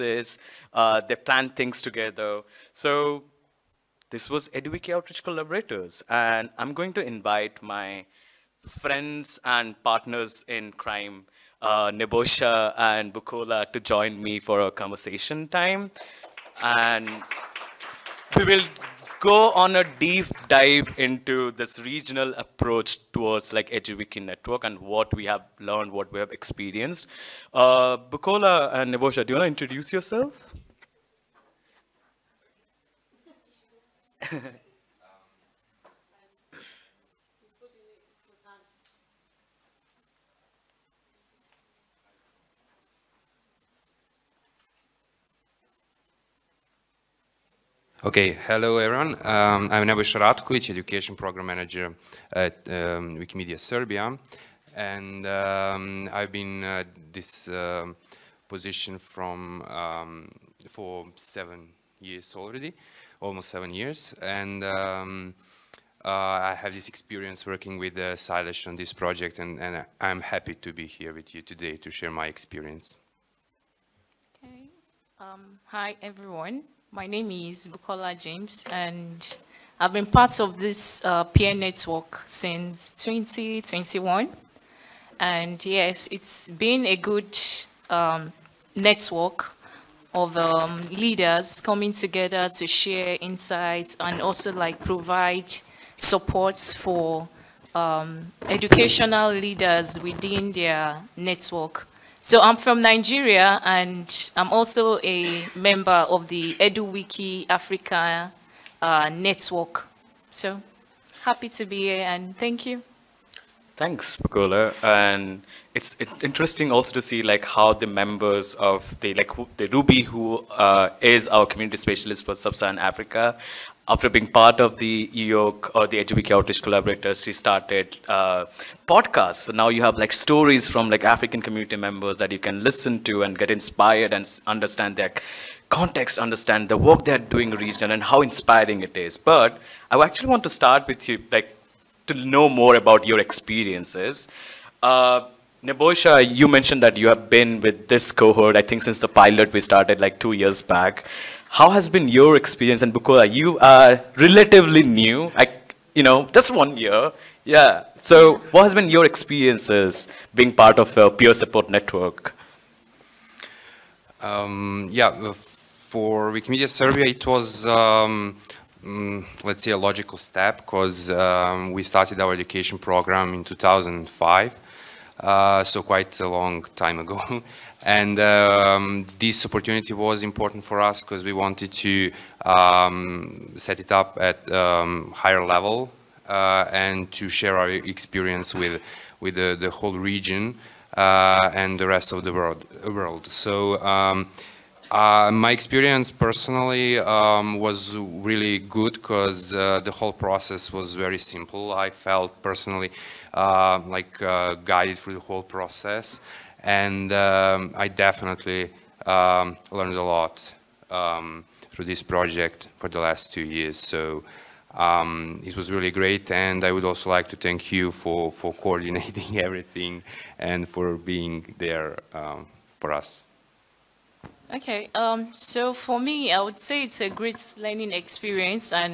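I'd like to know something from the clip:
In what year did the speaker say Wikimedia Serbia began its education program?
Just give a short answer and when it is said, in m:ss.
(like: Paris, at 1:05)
2005, at 2:53.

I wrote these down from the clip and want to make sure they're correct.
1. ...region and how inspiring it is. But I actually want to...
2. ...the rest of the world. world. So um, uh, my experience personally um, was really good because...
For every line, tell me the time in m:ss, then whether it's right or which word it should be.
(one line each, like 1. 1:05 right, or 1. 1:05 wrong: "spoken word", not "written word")
1. 2:17 right
2. 3:11 right.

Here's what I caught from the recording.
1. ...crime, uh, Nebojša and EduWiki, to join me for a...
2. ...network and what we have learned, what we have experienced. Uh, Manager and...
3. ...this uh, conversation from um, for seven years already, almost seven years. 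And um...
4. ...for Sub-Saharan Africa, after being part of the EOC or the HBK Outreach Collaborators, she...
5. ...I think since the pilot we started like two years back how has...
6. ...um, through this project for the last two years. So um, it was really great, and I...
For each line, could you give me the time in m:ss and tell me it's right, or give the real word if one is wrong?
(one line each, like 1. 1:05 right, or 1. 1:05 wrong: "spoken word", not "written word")
1. 0:10 wrong: "Bukola", not "EduWiki"
2. 0:24 wrong: "Bukola", not "Manager"
3. 0:57 wrong: "position", not "conversation"
4. 2:02 right
5. 2:28 right
6. 3:30 right.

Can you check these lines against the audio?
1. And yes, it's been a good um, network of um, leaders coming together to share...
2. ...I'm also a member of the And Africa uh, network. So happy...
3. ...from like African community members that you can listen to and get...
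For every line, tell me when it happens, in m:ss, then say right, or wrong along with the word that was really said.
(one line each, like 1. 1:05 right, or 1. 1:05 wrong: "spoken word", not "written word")
1. 1:25 right
2. 1:44 wrong: "EduWiki", not "And"
3. 2:10 right.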